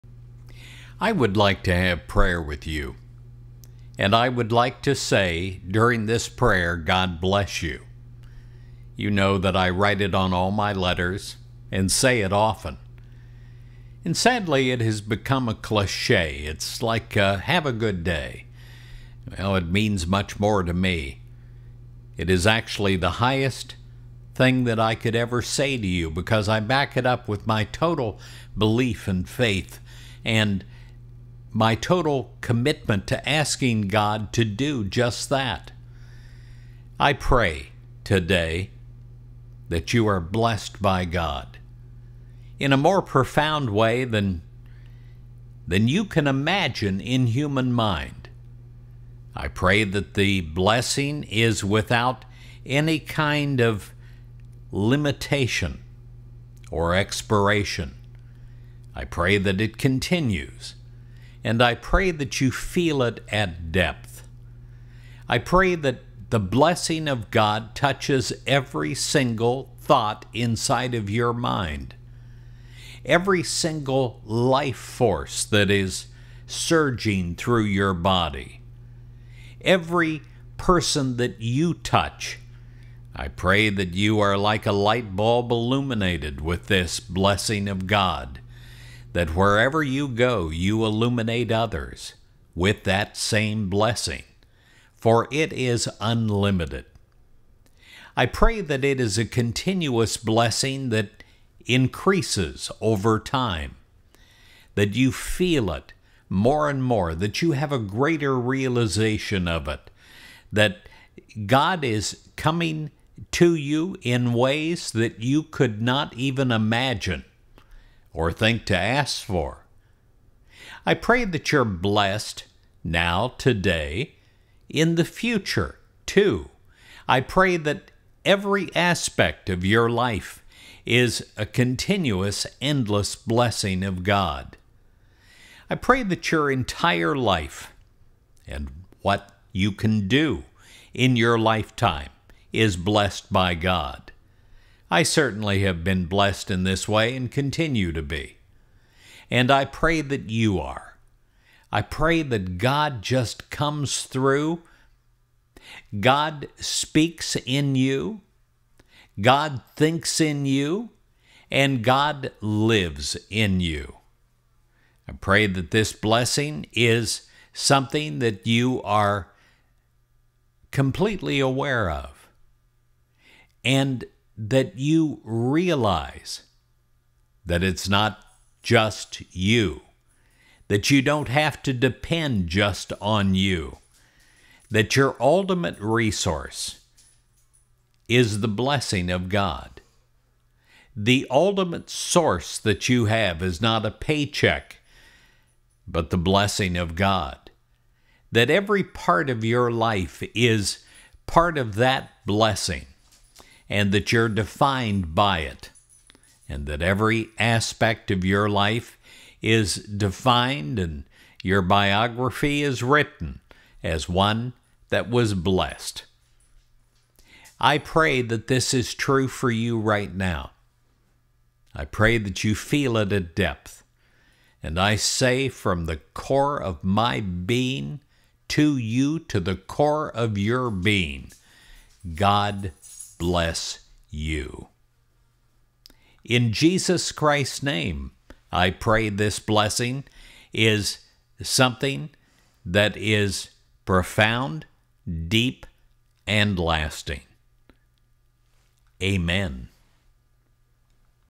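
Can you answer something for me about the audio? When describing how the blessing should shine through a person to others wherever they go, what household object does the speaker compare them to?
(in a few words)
A light bulb.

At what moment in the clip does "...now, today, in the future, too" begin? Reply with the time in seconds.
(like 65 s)
122 s.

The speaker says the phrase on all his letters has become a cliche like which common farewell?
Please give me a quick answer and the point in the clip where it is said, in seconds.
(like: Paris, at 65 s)
Have a good day, at 17 s.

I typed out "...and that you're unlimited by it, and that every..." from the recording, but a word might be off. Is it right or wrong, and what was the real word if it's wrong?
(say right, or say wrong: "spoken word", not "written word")
wrong: "defined", not "unlimited".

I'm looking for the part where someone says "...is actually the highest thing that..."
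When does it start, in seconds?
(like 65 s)
22 s.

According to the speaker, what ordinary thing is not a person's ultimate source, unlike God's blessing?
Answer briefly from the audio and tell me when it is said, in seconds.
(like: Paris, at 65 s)
A paycheck, at 193 s.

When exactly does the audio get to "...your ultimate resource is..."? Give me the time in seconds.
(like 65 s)
184 s.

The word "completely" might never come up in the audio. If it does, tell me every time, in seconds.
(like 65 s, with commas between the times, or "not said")
170 s.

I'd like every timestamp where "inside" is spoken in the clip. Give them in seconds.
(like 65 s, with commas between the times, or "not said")
70 s.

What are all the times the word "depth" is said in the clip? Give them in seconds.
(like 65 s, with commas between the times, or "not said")
63 s, 223 s.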